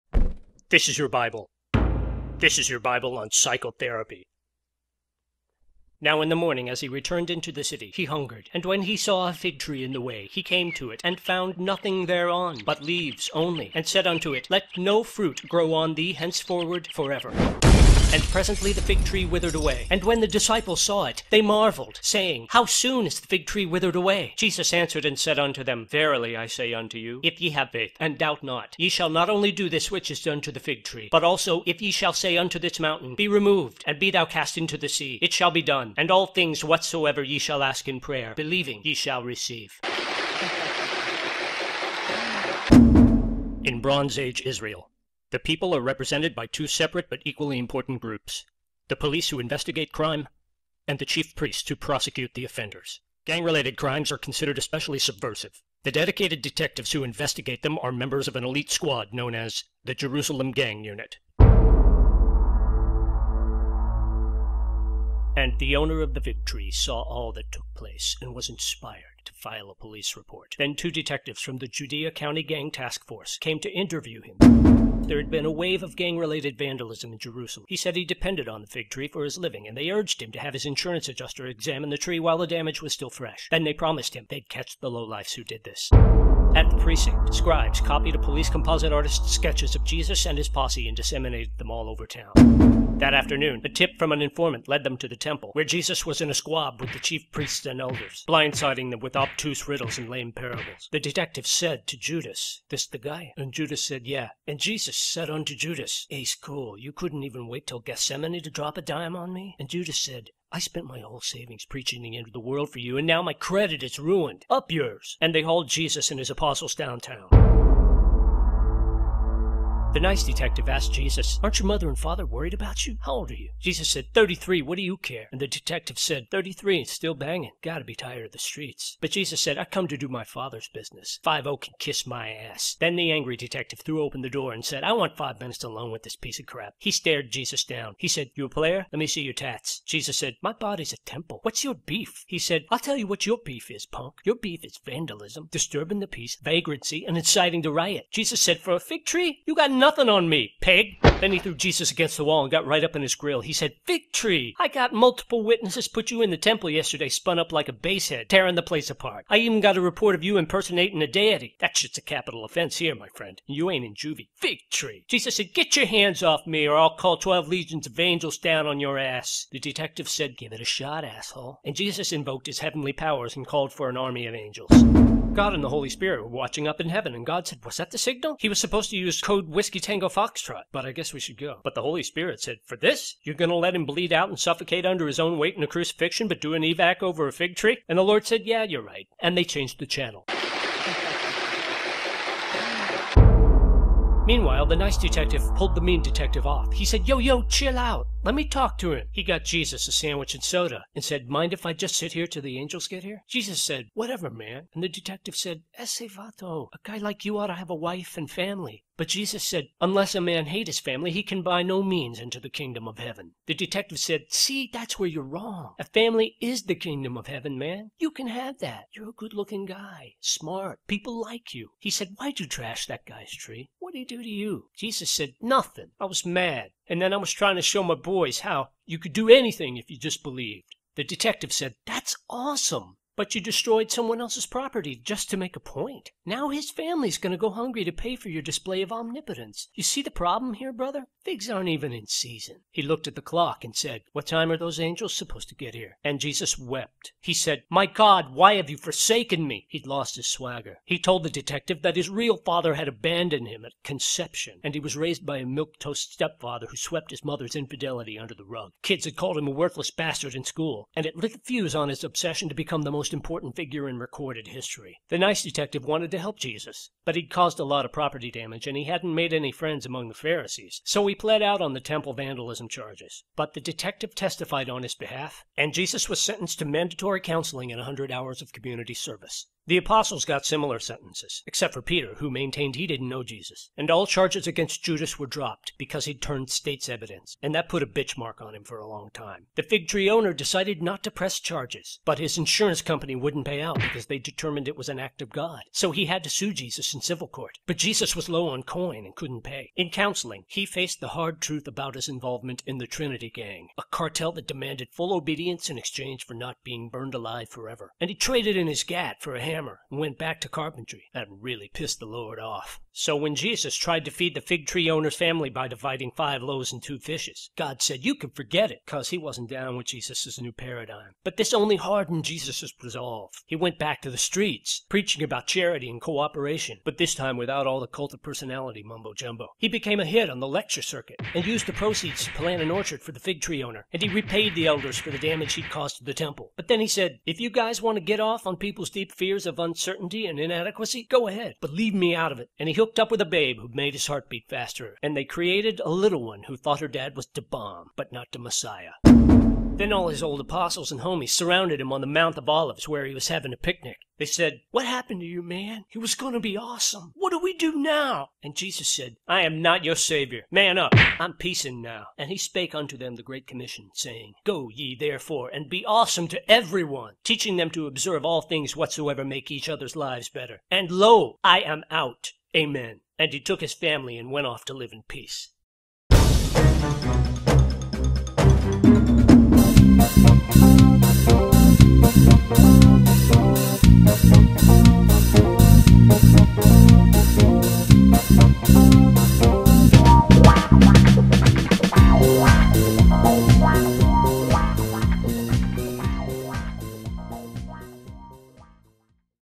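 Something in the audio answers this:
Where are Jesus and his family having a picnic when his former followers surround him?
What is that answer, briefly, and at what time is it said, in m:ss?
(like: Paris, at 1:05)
Mount of Olives, at 5:52.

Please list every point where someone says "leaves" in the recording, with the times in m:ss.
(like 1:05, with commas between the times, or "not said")
0:12, 5:41.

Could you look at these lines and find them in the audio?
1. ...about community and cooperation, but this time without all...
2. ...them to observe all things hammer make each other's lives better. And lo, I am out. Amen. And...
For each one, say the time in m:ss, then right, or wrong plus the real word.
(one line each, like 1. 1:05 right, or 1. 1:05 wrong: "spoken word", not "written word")
1. 5:25 wrong: "charity", not "community"
2. 6:07 wrong: "whatsoever", not "hammer".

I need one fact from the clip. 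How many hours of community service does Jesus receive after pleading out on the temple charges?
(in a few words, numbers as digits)
100.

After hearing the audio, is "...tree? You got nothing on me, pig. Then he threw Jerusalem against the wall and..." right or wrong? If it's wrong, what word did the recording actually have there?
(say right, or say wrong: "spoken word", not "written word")
wrong: "Jesus", not "Jerusalem".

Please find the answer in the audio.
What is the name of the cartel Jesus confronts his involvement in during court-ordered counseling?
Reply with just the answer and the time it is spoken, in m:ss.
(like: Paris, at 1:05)
Trinity Gang, at 5:02.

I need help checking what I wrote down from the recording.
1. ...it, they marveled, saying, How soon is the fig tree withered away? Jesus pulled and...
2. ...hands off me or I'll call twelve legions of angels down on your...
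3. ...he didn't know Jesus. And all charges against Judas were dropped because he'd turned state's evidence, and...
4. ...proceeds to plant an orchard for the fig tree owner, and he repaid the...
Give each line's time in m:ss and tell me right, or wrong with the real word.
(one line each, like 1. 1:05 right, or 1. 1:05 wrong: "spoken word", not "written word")
1. 0:21 wrong: "answered", not "pulled"
2. 2:45 right
3. 4:42 right
4. 5:31 right.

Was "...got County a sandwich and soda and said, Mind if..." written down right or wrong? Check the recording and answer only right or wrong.
wrong.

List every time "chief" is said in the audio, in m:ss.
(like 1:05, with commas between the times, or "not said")
0:51, 1:36.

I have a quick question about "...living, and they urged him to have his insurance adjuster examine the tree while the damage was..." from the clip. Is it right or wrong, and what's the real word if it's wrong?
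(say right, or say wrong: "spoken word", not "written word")
right.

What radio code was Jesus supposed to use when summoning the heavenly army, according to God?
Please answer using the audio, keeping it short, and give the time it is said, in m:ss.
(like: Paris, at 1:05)
Whiskey Tango Foxtrot, at 2:59.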